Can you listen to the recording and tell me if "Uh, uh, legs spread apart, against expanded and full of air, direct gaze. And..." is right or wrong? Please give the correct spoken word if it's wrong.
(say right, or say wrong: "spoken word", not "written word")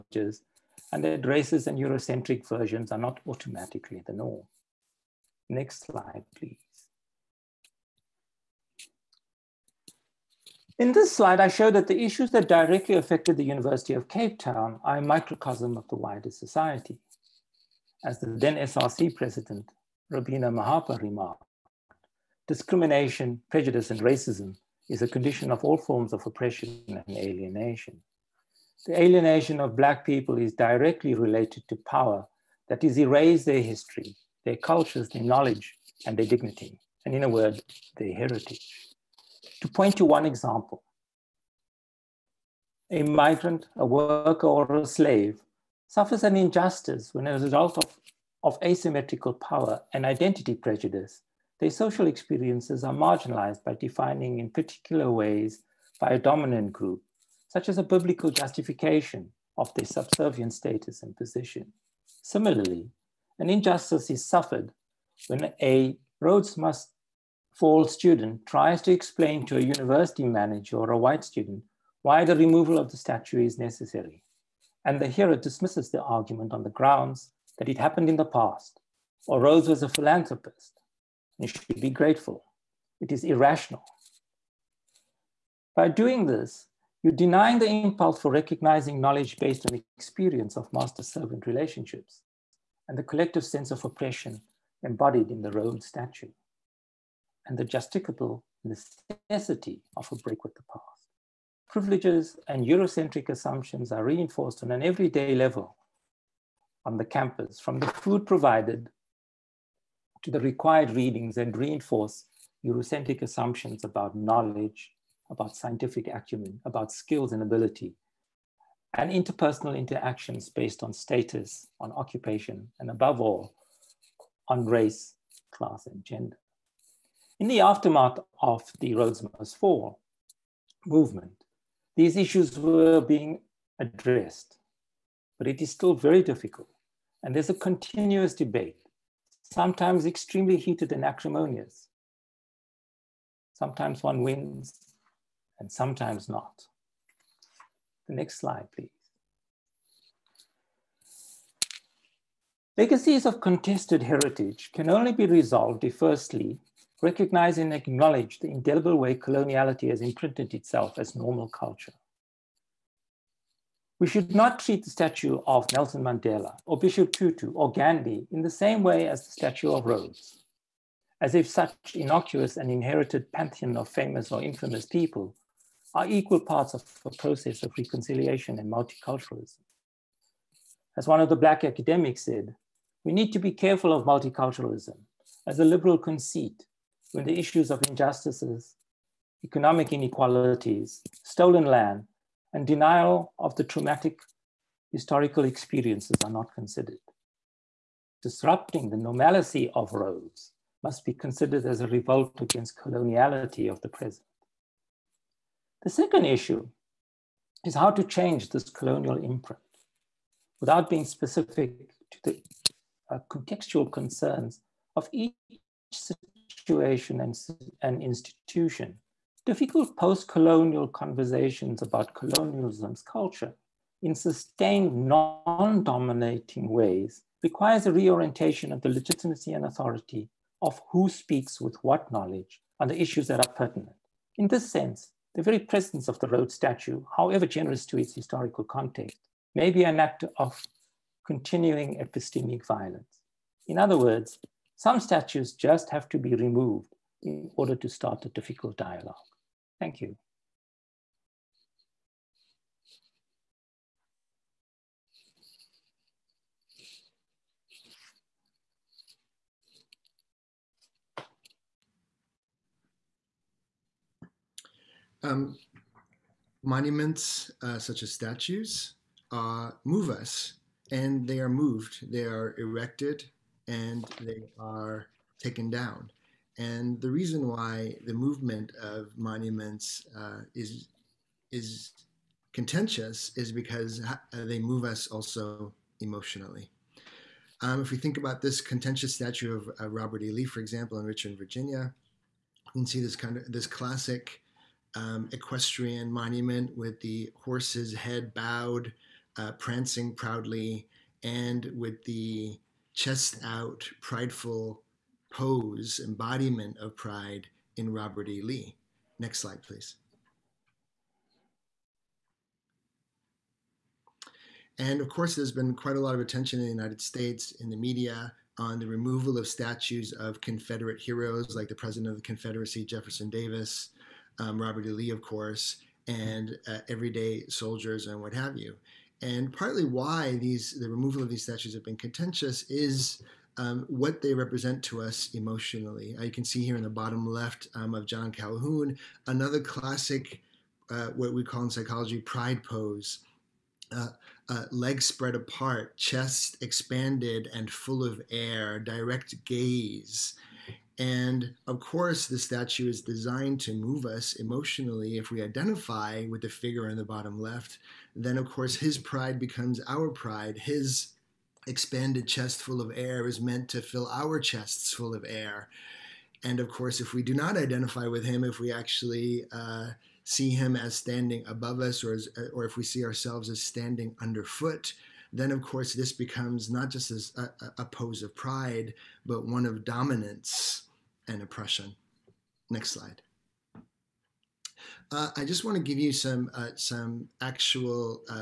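wrong: "chest", not "against".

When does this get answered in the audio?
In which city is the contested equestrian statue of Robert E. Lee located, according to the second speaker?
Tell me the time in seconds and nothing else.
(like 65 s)
291 s.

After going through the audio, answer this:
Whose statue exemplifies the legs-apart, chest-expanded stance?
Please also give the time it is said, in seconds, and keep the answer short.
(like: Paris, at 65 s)
John Calhoun, at 338 s.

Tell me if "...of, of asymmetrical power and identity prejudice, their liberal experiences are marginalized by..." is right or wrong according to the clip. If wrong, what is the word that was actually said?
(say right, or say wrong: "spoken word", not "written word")
wrong: "social", not "liberal".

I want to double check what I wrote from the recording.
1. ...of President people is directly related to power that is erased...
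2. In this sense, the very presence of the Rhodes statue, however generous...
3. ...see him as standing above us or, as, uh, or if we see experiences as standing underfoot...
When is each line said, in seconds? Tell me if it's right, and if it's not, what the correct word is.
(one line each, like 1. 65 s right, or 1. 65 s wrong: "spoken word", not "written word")
1. 29 s wrong: "Black", not "President"
2. 234 s right
3. 370 s wrong: "ourselves", not "experiences".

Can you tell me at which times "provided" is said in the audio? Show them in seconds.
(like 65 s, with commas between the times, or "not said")
108 s.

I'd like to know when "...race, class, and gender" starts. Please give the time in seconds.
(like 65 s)
124 s.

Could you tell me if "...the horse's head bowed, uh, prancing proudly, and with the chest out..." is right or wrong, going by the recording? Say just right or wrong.
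right.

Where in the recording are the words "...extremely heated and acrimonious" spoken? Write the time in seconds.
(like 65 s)
140 s.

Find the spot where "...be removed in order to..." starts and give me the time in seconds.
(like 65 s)
246 s.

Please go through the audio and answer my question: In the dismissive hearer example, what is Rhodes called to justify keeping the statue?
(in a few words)
a philanthropist.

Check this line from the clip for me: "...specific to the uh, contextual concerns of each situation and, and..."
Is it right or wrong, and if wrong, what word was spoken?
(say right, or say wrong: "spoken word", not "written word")
right.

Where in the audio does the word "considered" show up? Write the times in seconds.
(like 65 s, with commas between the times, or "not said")
196 s, 201 s.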